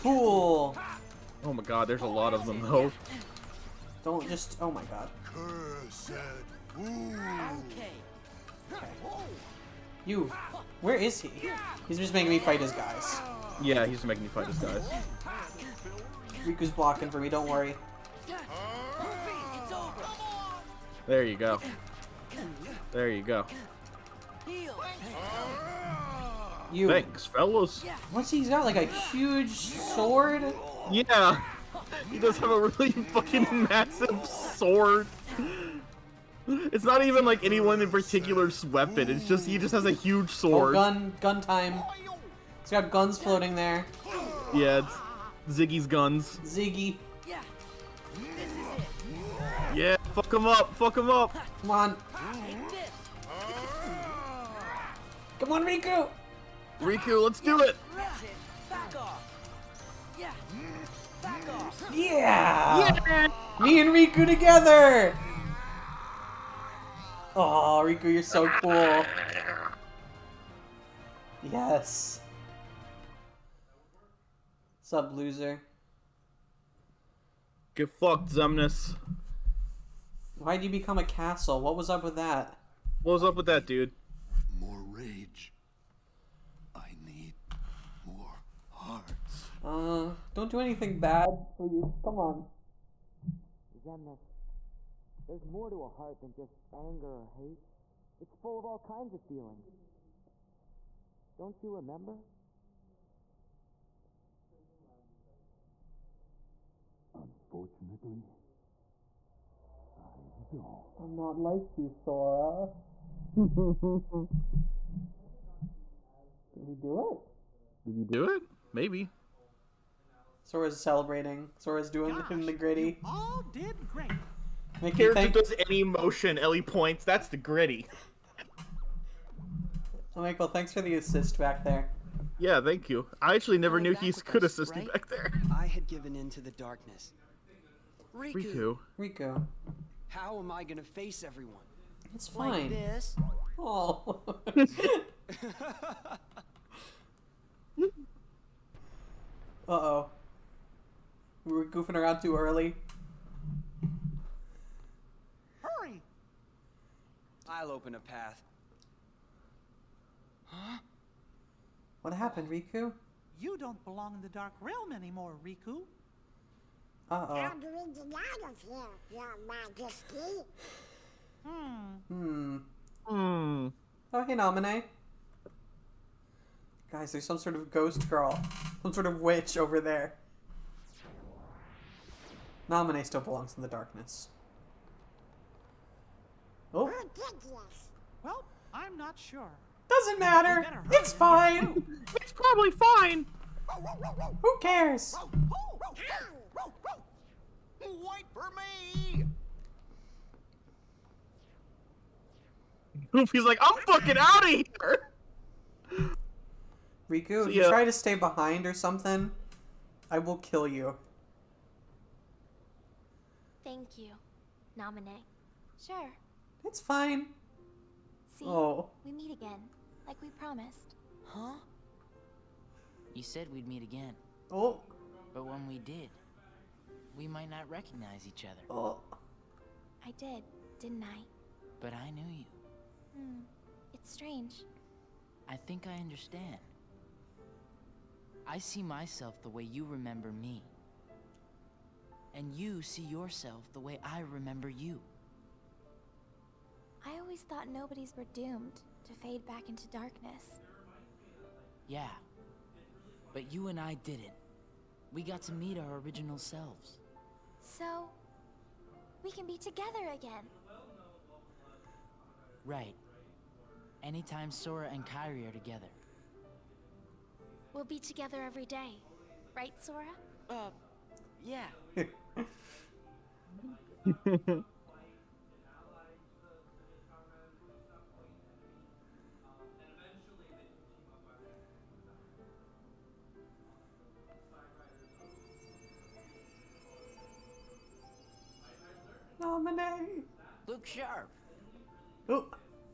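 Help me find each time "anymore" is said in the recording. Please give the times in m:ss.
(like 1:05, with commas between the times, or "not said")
2:44.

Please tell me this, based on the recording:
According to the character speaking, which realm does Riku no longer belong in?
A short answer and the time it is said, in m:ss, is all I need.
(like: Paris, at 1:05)
The Dark Realm, at 2:44.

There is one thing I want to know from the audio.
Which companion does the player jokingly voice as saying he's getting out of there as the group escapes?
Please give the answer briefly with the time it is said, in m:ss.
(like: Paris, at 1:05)
Goofy, at 3:23.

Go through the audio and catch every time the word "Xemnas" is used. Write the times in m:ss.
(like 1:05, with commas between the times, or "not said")
1:18, 1:33.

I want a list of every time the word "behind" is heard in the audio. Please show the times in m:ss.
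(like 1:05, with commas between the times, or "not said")
3:28.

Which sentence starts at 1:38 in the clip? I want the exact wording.
It's full of all kinds of feelings.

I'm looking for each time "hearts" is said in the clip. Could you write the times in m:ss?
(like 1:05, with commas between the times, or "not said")
1:28, 1:35.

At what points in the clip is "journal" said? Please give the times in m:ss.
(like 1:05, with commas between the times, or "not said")
not said.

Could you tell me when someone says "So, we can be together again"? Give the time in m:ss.
4:17.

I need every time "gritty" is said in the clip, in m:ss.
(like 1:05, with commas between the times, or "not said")
2:02, 2:07.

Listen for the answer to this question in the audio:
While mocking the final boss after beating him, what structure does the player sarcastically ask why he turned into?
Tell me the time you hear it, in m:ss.
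1:21.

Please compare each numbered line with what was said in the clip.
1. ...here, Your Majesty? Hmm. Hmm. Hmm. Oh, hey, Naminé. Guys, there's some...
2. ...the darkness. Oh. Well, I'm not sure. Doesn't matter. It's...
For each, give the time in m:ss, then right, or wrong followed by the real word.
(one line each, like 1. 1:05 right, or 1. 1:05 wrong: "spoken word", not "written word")
1. 2:48 right
2. 3:03 right.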